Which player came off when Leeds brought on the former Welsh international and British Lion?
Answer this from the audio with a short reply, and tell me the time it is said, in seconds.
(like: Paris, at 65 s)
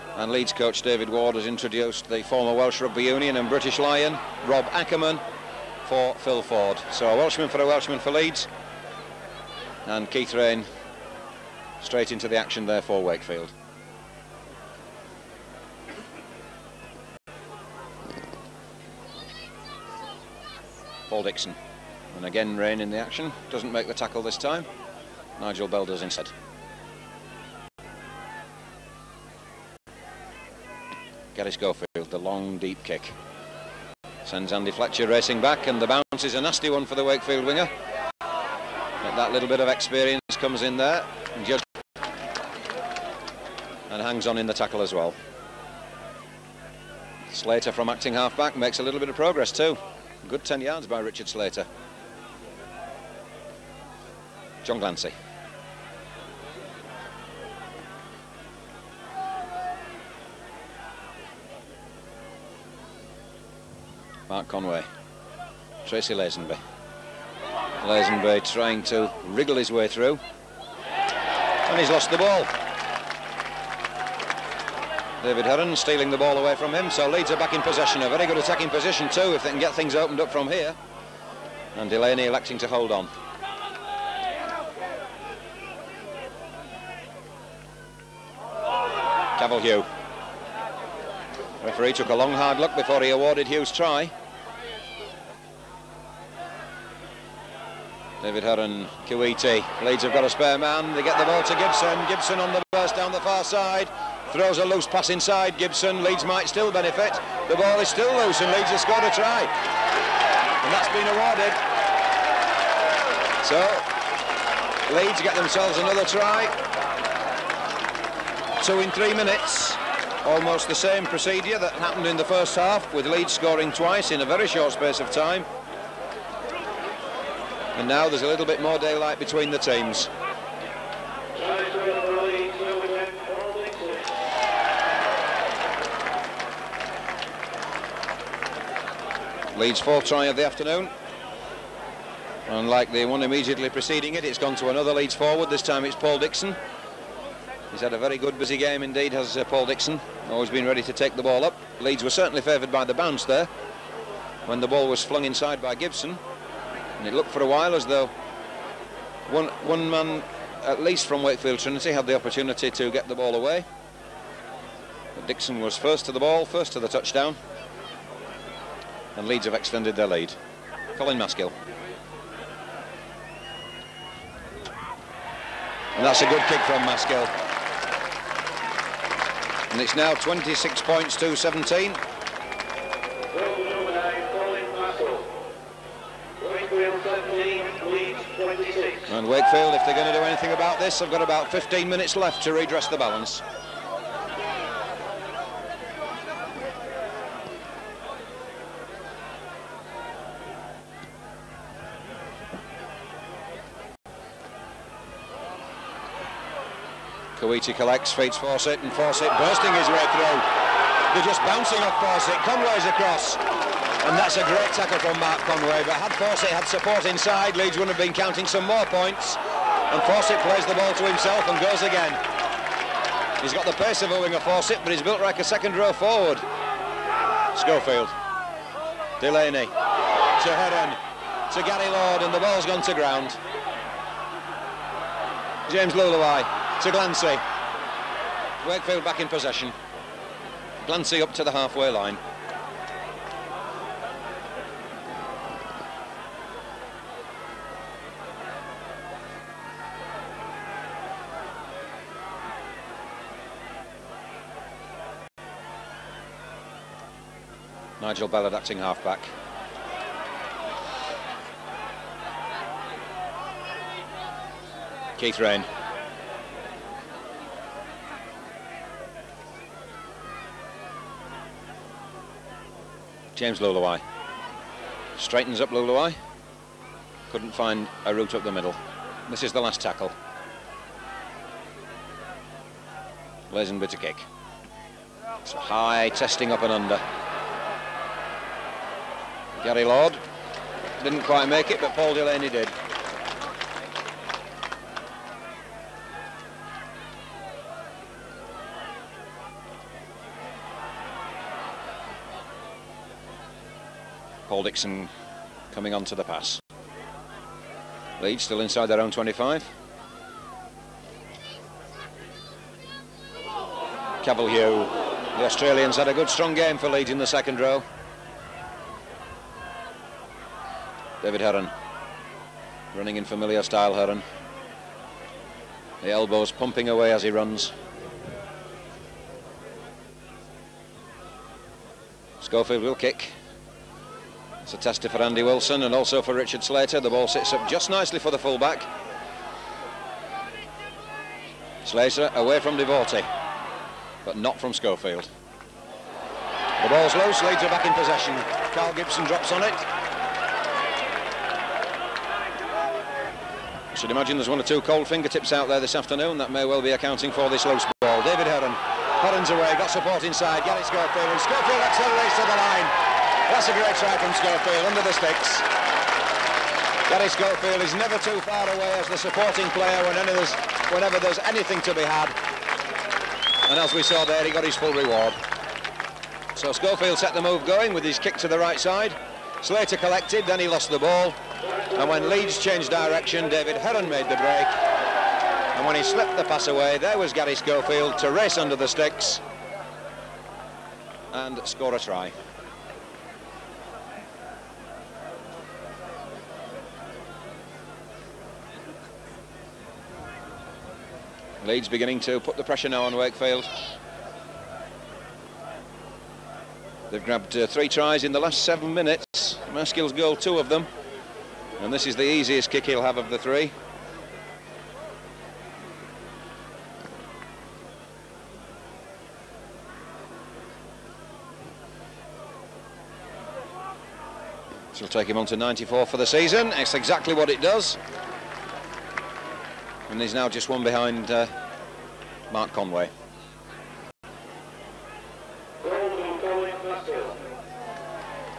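Phil Ford, at 6 s.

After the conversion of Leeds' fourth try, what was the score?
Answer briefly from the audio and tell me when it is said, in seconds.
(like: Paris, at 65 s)
26 to 17, at 180 s.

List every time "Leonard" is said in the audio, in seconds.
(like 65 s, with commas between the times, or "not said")
not said.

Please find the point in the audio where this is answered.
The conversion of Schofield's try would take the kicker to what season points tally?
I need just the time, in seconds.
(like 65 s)
425 s.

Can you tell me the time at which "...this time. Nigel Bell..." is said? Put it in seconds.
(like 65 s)
24 s.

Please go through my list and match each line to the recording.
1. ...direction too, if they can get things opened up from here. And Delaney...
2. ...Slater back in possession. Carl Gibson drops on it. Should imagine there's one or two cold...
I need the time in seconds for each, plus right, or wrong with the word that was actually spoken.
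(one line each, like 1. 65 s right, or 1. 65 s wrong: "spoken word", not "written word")
1. 78 s wrong: "position", not "direction"
2. 347 s right.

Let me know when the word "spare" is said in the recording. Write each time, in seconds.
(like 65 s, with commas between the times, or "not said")
100 s.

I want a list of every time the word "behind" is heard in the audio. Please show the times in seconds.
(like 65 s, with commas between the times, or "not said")
430 s.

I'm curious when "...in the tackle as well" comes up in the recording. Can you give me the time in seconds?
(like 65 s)
44 s.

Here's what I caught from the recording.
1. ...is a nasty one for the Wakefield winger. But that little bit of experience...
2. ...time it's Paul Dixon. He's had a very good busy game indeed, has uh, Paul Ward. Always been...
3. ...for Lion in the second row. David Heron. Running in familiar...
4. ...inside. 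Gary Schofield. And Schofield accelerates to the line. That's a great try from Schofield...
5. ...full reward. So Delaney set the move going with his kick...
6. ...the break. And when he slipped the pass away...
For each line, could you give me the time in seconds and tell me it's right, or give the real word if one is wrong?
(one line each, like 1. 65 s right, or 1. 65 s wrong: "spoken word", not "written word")
1. 36 s right
2. 145 s wrong: "Dixon", not "Ward"
3. 316 s wrong: "Leeds", not "Lion"
4. 360 s right
5. 374 s wrong: "Schofield", not "Delaney"
6. 384 s right.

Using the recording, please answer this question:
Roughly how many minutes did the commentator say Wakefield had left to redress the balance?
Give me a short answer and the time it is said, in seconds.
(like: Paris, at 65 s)
15, at 191 s.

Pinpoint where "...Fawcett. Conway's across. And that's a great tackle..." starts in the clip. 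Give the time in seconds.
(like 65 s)
212 s.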